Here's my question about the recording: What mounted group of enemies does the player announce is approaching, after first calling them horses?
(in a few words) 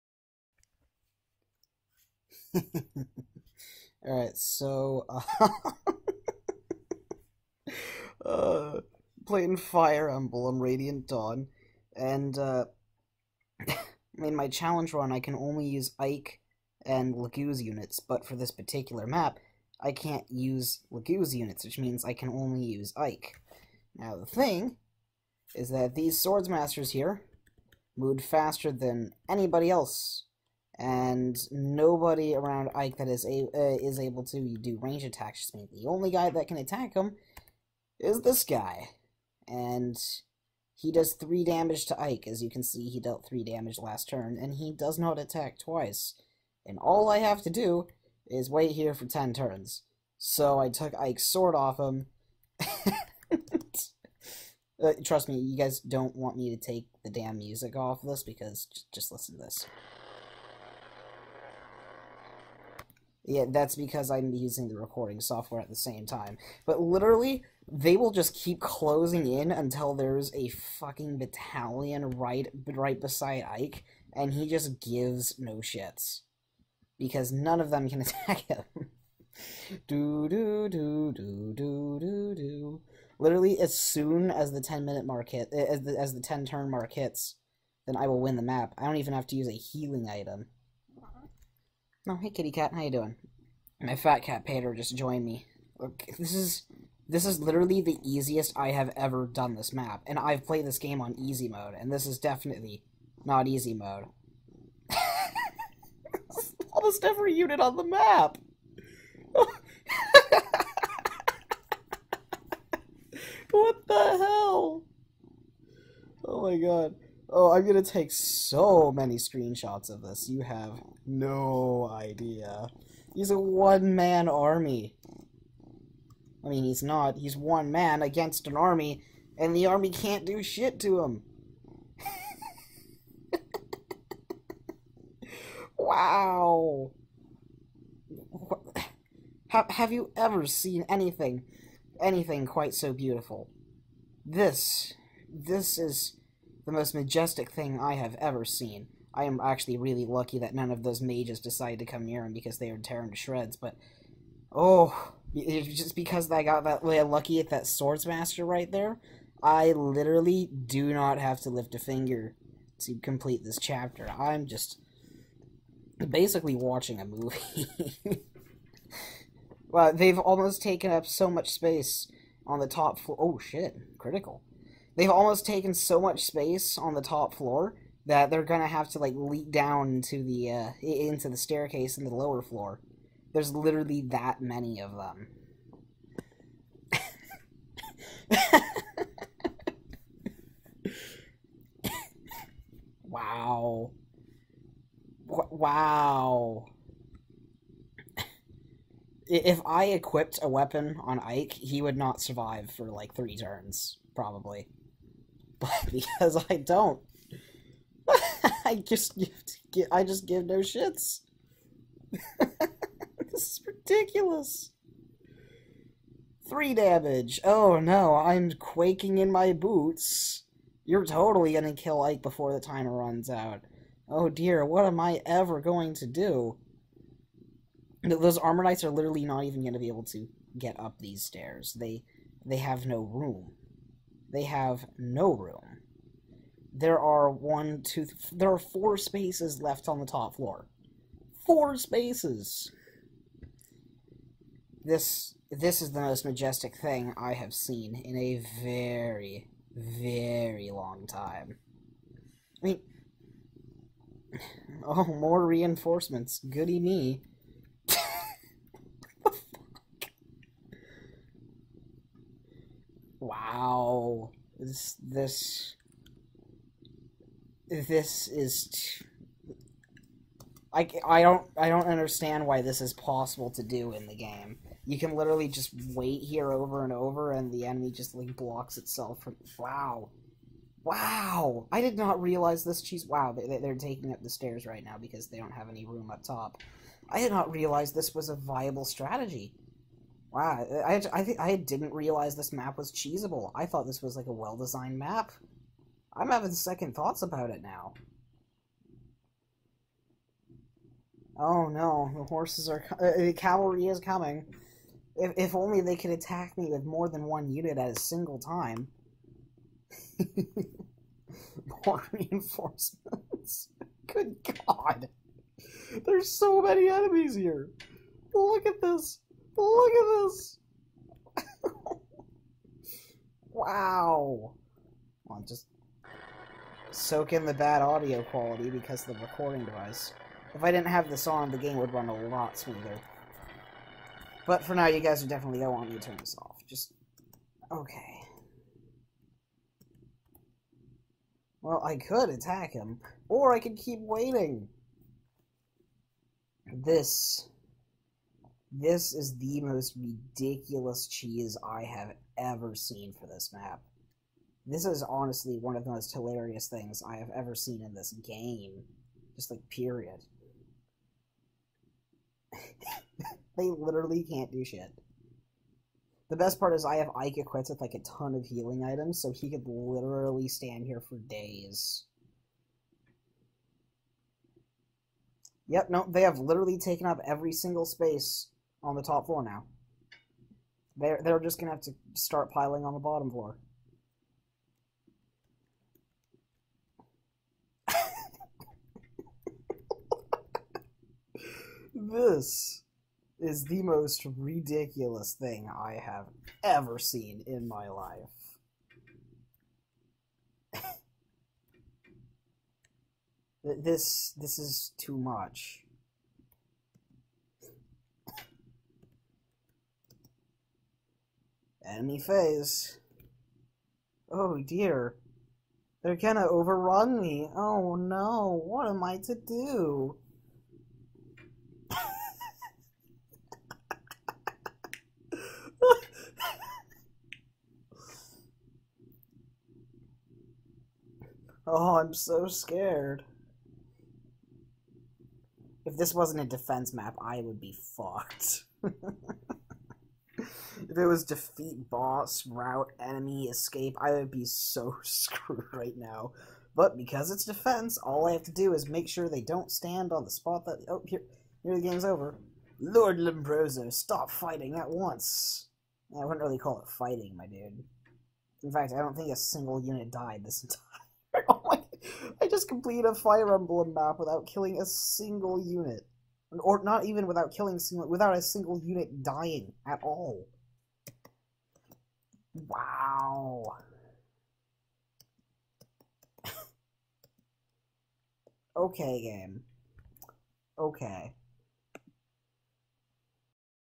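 the cavalry.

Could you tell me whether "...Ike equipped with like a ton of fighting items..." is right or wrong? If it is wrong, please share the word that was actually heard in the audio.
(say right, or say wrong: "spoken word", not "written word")
wrong: "healing", not "fighting".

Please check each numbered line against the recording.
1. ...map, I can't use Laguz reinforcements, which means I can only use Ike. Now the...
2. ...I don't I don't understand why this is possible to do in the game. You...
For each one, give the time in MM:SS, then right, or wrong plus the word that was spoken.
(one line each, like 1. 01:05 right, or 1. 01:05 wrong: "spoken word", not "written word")
1. 00:19 wrong: "units", not "reinforcements"
2. 04:31 right.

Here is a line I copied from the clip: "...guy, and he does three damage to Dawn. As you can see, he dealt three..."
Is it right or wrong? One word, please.
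wrong.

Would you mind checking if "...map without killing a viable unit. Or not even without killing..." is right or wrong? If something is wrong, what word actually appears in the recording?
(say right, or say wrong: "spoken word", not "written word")
wrong: "single", not "viable".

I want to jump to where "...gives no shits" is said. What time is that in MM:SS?
01:14.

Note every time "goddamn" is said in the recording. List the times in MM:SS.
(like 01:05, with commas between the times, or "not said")
not said.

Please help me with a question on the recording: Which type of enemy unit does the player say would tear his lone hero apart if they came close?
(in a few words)
mages.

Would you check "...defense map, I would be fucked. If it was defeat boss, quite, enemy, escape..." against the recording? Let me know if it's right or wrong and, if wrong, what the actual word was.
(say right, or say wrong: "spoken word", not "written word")
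wrong: "route", not "quite".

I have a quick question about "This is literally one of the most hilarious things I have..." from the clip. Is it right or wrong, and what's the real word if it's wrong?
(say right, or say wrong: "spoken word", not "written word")
wrong: "honestly", not "literally".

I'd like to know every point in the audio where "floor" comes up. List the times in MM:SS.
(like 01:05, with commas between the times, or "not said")
02:52, 02:57, 03:02, 04:00, 06:19, 06:23.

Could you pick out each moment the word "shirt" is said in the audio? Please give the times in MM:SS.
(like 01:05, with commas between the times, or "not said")
not said.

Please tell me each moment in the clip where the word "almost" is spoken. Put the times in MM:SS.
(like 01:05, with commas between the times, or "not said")
01:46, 02:50, 02:55.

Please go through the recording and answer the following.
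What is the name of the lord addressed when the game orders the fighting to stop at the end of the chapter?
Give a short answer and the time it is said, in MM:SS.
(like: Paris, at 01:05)
Lombroso, at 07:33.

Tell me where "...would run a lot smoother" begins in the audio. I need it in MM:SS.
05:31.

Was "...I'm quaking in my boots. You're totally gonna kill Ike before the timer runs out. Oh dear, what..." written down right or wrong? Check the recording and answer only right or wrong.
right.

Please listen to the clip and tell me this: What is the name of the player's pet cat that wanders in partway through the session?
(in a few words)
Pater.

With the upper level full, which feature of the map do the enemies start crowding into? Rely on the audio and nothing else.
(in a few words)
the staircase.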